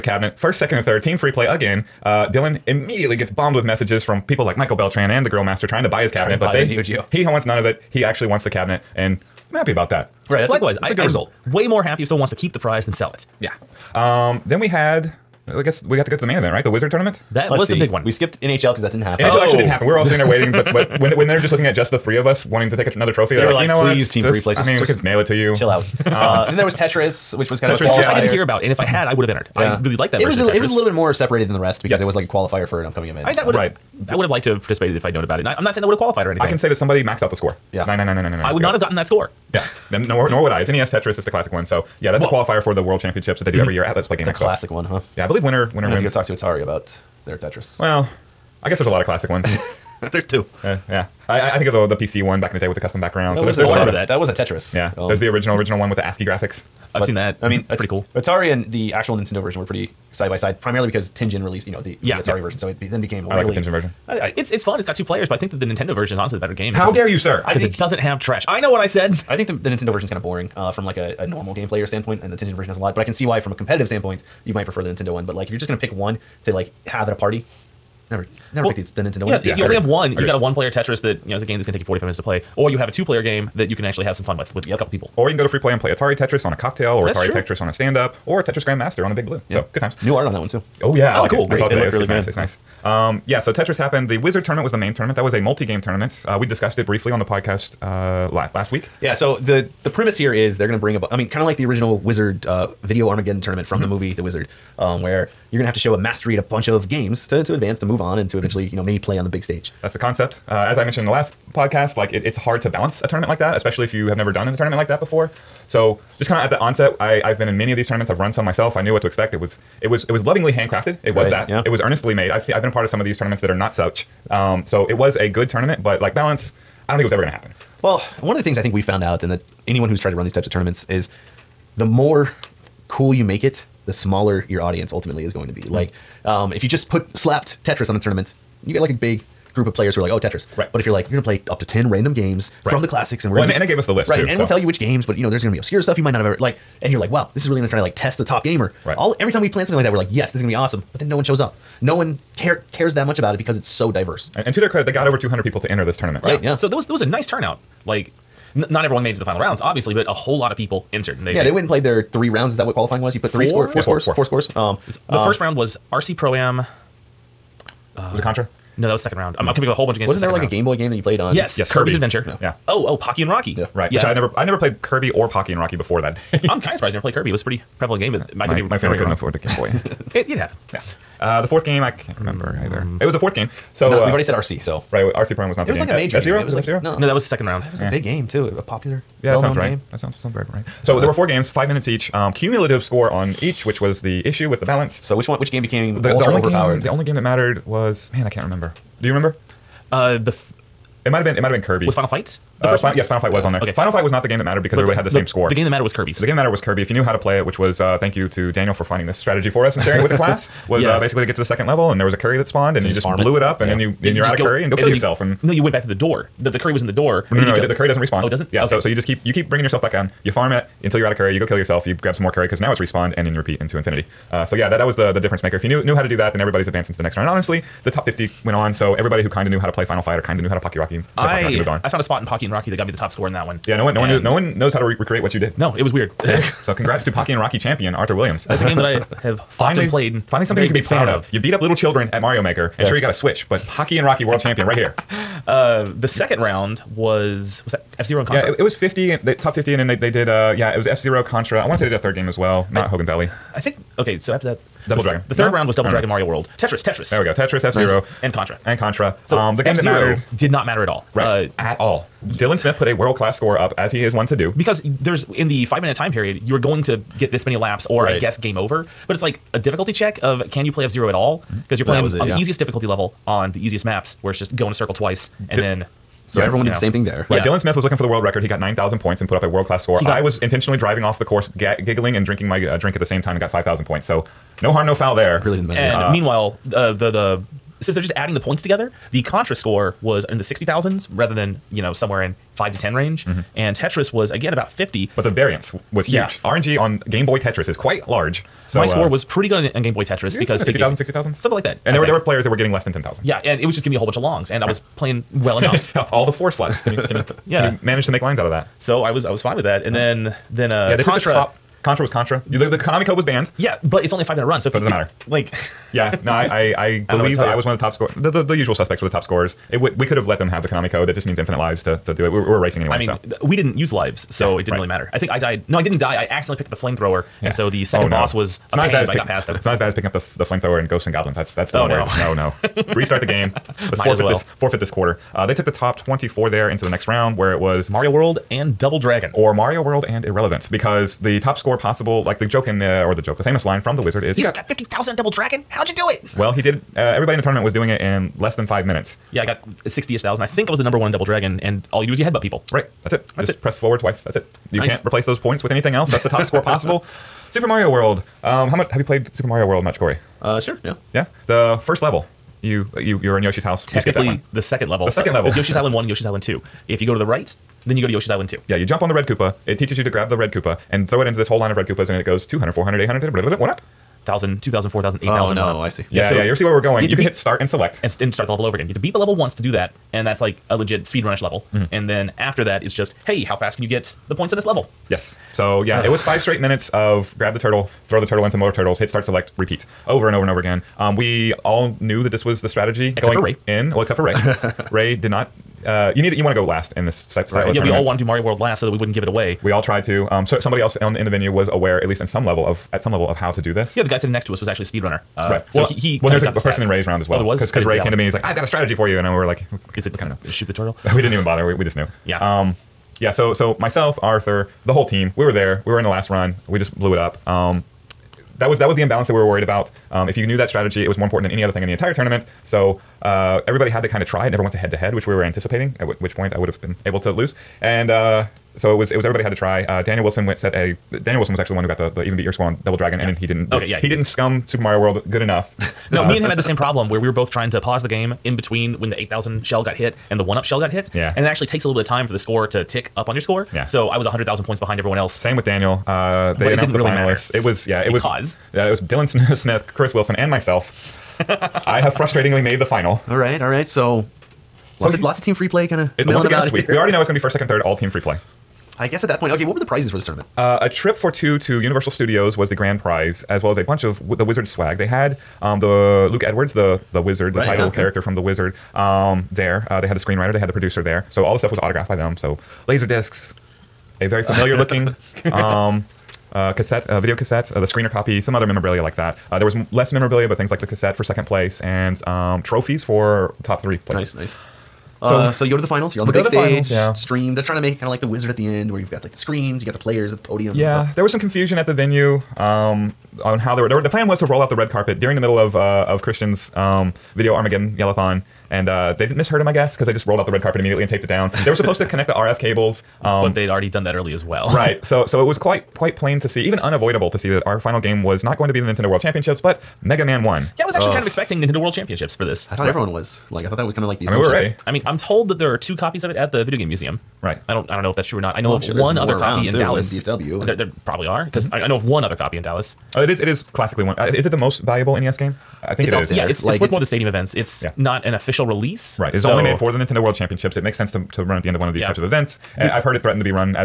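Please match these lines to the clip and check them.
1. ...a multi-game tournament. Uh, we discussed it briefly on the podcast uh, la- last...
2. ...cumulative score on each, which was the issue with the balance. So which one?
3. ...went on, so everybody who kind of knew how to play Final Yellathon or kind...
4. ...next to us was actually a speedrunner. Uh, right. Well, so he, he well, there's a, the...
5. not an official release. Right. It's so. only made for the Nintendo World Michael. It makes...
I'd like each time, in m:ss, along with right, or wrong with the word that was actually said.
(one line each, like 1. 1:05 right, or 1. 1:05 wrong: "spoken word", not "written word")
1. 1:35 right
2. 3:12 right
3. 3:48 wrong: "Fight", not "Yellathon"
4. 6:44 right
5. 8:47 wrong: "Championships", not "Michael".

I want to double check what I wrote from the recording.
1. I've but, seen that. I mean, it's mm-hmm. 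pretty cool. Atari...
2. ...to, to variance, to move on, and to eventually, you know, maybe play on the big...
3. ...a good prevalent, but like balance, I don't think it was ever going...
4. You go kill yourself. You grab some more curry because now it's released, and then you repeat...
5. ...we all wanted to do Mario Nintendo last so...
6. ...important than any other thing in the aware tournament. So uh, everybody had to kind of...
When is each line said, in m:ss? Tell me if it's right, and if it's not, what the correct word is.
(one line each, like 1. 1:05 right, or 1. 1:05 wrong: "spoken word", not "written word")
1. 0:56 right
2. 1:47 wrong: "advance", not "variance"
3. 2:05 wrong: "tournament", not "prevalent"
4. 3:41 wrong: "respawned", not "released"
5. 6:37 wrong: "World", not "Nintendo"
6. 7:01 wrong: "entire", not "aware".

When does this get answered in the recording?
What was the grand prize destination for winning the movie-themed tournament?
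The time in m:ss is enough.
7:41.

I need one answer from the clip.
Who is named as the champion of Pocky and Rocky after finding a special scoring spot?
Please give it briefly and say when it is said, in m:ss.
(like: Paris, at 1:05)
Arthur Williams, at 3:57.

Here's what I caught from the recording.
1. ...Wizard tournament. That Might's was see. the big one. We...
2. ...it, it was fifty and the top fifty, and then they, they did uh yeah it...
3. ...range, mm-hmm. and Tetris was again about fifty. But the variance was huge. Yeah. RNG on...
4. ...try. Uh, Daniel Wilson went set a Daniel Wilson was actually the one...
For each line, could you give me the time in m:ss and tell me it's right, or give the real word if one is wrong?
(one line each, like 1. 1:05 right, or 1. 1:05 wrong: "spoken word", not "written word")
1. 0:16 wrong: "Let", not "Might"
2. 4:08 right
3. 4:52 right
4. 7:09 right.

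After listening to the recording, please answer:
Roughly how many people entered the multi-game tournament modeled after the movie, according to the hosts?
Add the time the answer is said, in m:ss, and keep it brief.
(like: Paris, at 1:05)
over 200, at 2:35.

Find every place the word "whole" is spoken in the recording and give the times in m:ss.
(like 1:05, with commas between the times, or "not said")
2:40, 2:49, 5:03, 6:11, 6:54.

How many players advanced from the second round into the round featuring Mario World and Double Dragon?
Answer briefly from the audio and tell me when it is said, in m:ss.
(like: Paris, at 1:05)
24, at 5:35.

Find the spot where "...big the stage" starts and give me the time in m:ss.
8:06.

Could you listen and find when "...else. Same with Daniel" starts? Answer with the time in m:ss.
7:25.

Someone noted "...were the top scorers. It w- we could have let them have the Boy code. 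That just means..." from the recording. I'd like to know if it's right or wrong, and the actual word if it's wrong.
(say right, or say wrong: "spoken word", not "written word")
wrong: "Konami", not "Boy".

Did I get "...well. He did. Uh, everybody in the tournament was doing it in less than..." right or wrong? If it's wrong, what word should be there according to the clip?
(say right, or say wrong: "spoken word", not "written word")
right.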